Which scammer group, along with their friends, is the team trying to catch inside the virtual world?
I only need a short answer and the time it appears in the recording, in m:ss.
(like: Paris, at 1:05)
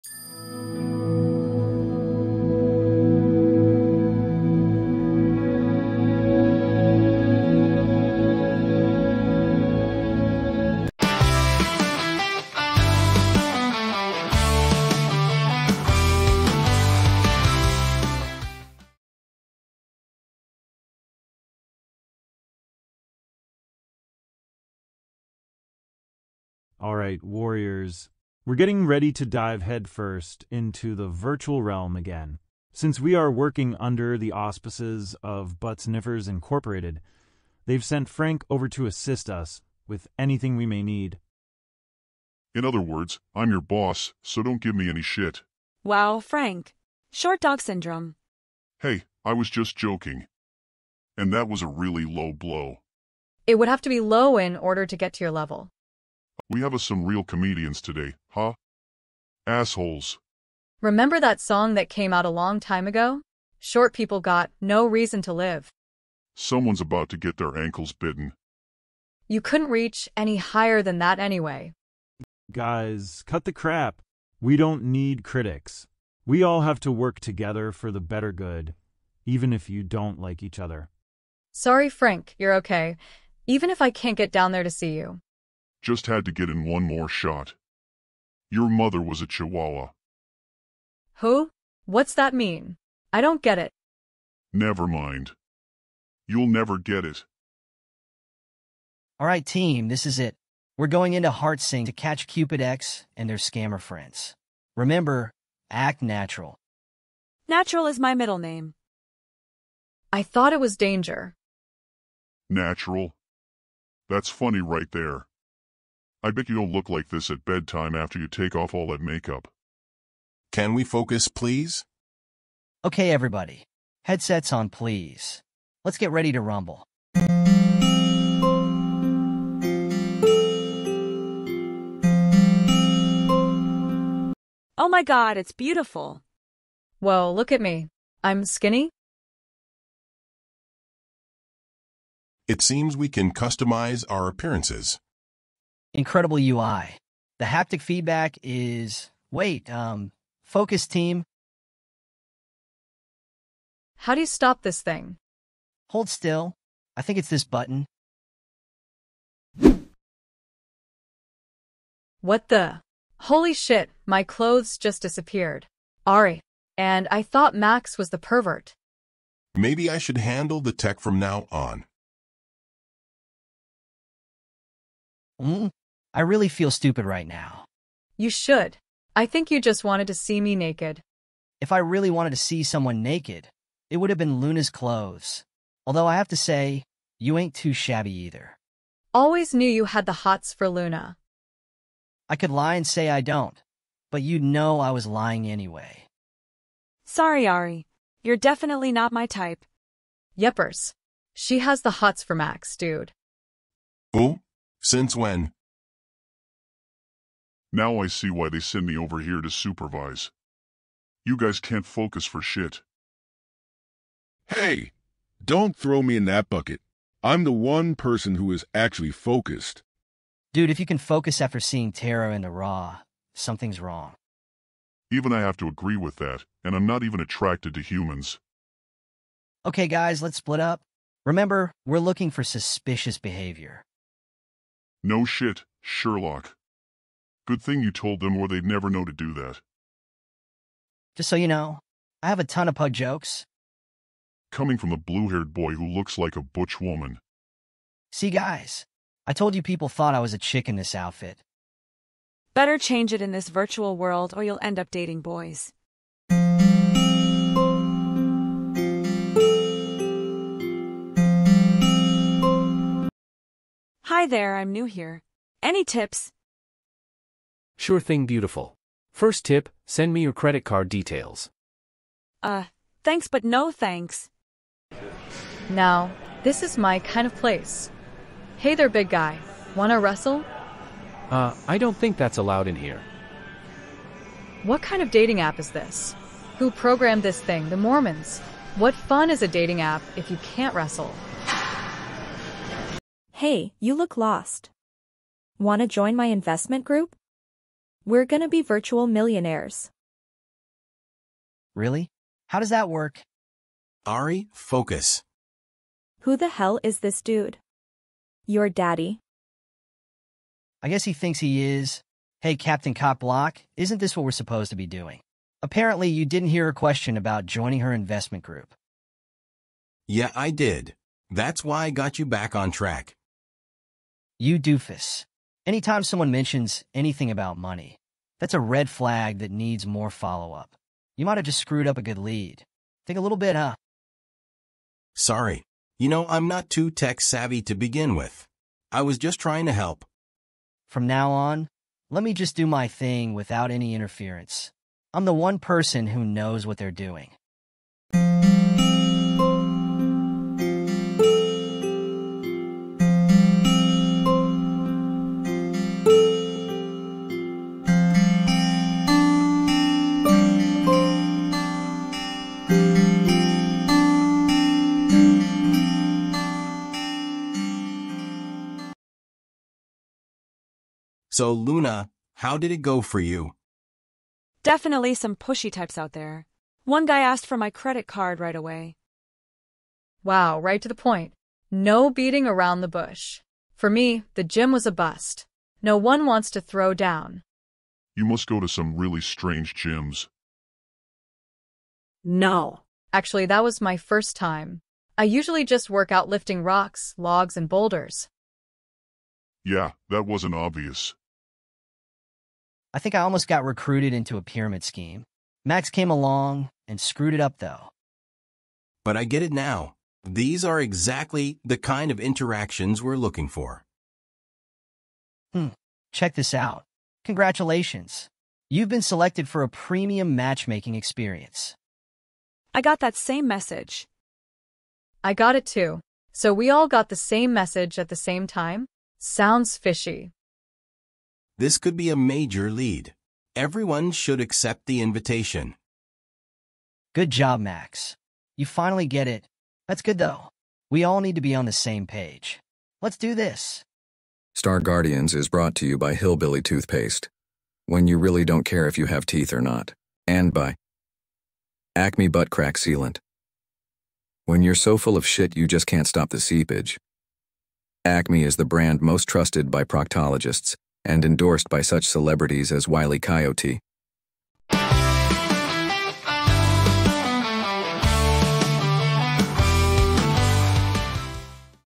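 Cupid X, at 1:42.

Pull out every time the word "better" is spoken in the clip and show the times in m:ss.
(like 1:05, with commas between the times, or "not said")
1:18, 4:12.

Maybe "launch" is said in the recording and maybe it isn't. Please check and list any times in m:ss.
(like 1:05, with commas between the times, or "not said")
not said.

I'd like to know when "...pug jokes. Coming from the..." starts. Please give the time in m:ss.
4:02.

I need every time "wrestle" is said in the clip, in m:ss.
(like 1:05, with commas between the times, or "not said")
4:39, 4:50.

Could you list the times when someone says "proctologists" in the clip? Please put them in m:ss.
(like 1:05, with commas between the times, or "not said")
7:39.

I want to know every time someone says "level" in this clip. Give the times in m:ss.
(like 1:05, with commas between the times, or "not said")
0:55.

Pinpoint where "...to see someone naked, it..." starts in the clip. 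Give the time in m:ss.
3:02.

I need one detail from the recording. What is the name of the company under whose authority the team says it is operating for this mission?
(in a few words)
Butts Niffers Incorporated.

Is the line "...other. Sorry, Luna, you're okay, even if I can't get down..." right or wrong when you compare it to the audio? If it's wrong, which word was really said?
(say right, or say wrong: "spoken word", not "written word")
wrong: "Frank", not "Luna".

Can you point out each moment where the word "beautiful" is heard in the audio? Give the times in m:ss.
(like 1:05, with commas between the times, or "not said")
2:15, 4:28.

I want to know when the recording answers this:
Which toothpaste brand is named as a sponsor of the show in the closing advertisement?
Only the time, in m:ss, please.
7:26.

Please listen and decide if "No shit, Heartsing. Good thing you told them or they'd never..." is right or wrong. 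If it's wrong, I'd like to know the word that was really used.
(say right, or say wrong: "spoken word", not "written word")
wrong: "Sherlock", not "Heartsing".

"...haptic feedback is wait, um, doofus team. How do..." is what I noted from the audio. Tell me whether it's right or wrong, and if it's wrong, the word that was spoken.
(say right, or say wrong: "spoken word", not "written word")
wrong: "focus", not "doofus".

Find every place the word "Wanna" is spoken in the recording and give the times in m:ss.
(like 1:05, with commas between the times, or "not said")
4:39, 4:55.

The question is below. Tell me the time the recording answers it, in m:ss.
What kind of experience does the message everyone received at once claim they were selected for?
6:59.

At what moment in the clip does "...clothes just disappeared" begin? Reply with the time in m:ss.
2:44.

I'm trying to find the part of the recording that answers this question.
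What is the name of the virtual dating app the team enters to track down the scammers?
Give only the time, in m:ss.
1:41.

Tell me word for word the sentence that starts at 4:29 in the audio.
First tip, send me your credit card details.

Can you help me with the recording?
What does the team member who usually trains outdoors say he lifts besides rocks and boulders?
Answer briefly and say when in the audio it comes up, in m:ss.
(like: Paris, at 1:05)
logs, at 6:37.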